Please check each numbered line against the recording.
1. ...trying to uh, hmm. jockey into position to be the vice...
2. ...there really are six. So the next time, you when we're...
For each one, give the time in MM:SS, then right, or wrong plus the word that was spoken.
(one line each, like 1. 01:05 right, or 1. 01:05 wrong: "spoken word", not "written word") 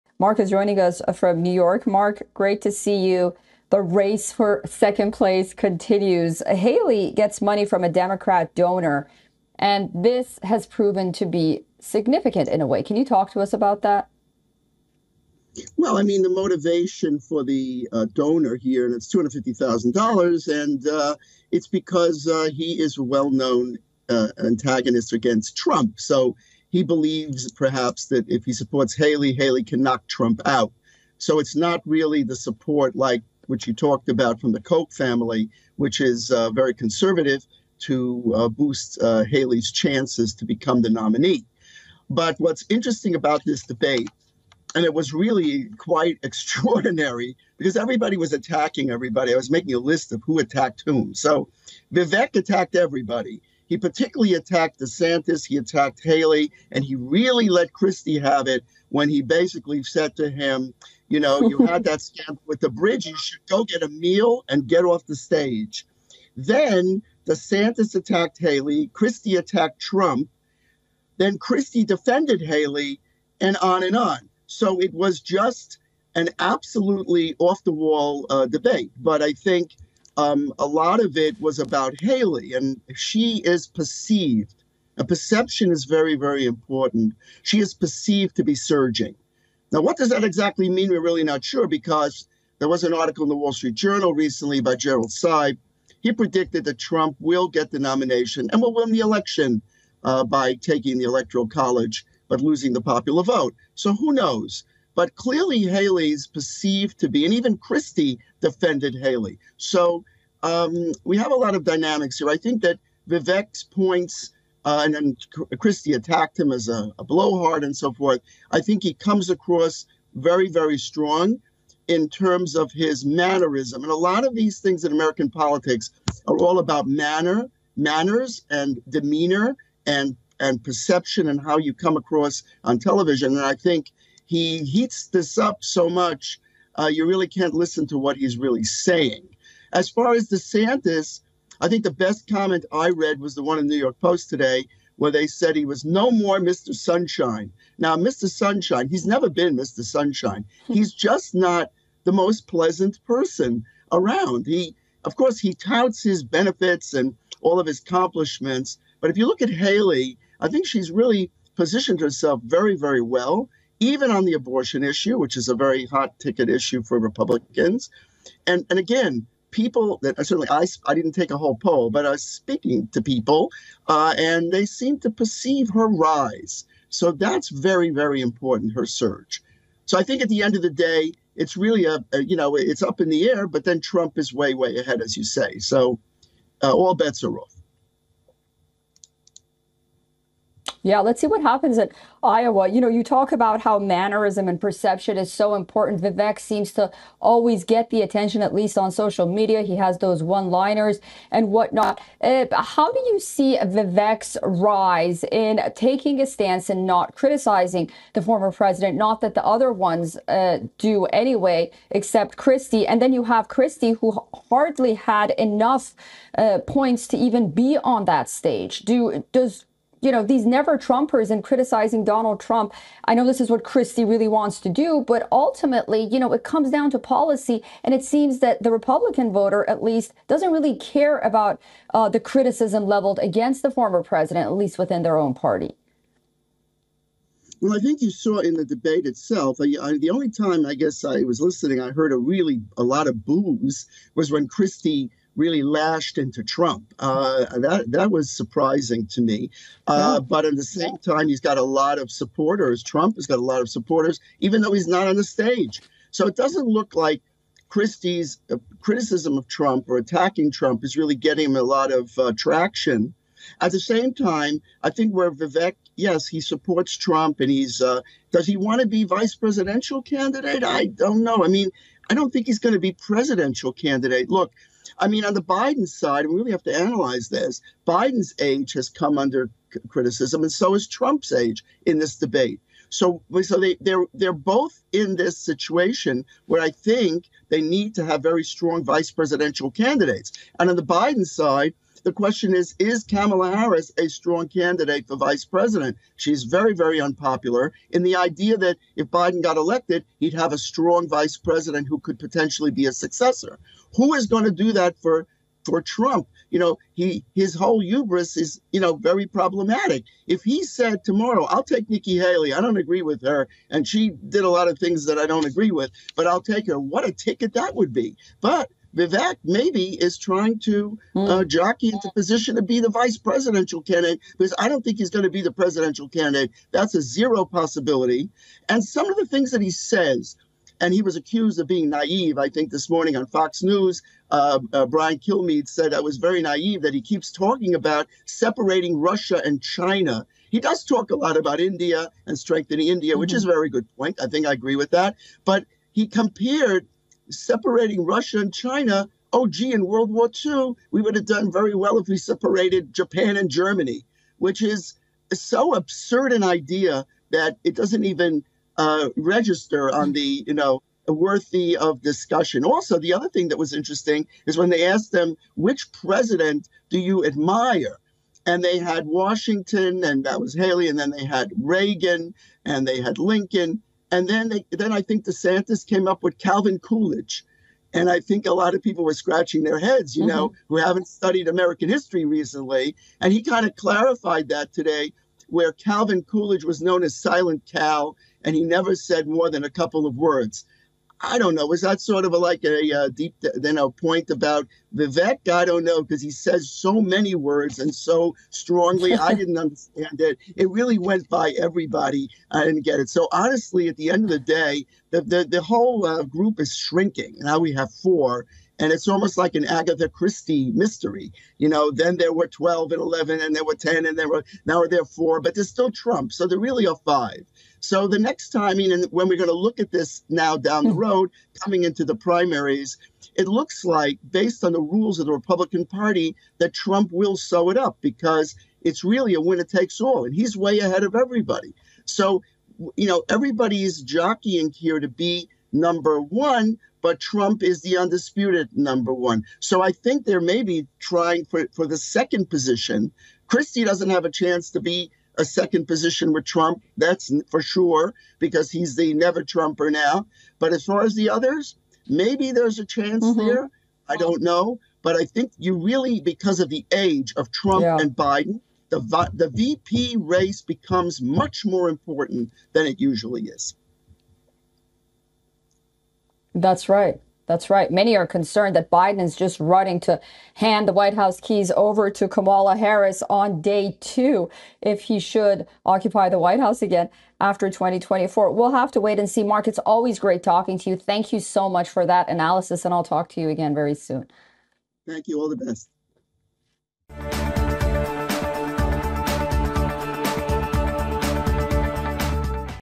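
1. 05:20 right
2. 06:56 wrong: "five", not "six".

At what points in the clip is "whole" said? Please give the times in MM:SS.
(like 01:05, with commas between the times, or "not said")
02:51, 05:07, 06:45.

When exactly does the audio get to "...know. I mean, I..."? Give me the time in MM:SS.
04:31.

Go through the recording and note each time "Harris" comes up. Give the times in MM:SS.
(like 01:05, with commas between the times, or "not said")
04:53, 07:52.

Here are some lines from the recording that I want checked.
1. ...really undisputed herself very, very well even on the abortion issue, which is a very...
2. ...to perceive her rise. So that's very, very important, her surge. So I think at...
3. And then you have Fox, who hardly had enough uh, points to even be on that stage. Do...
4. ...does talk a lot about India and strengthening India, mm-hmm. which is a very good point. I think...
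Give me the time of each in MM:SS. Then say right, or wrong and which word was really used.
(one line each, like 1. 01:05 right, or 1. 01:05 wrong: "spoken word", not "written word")
1. 02:40 wrong: "positioned", not "undisputed"
2. 02:54 right
3. 03:32 wrong: "Christie", not "Fox"
4. 05:40 right.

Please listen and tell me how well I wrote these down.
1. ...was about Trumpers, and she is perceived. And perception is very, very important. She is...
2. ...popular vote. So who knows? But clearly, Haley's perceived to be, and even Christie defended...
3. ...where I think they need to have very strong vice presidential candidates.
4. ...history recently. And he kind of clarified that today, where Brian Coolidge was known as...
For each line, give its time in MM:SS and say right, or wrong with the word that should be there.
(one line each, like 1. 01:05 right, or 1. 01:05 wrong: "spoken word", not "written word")
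1. 01:21 wrong: "Haley", not "Trumpers"
2. 01:42 right
3. 04:46 right
4. 06:21 wrong: "Calvin", not "Brian".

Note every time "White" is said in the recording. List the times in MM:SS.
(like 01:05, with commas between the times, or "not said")
07:50, 07:56.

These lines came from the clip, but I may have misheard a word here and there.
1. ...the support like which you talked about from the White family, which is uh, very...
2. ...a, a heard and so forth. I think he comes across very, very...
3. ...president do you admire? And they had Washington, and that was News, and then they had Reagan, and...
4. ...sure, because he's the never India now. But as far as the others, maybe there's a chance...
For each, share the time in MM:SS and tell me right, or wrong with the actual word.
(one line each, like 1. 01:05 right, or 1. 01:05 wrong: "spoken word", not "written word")
1. 00:32 wrong: "Koch", not "White"
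2. 01:56 wrong: "blowhard", not "heard"
3. 06:05 wrong: "Haley", not "News"
4. 07:27 wrong: "Trumper", not "India".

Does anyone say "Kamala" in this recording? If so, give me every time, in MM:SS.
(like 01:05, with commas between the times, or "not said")
04:53, 07:52.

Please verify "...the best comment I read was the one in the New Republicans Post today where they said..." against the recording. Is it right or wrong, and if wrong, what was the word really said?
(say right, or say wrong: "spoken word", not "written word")
wrong: "York", not "Republicans".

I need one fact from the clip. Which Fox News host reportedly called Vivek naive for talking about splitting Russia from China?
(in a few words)
Brian Kilmeade.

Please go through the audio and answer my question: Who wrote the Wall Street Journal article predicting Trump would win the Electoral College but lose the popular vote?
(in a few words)
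Gerald Seib.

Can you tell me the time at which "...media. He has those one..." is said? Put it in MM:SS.
03:19.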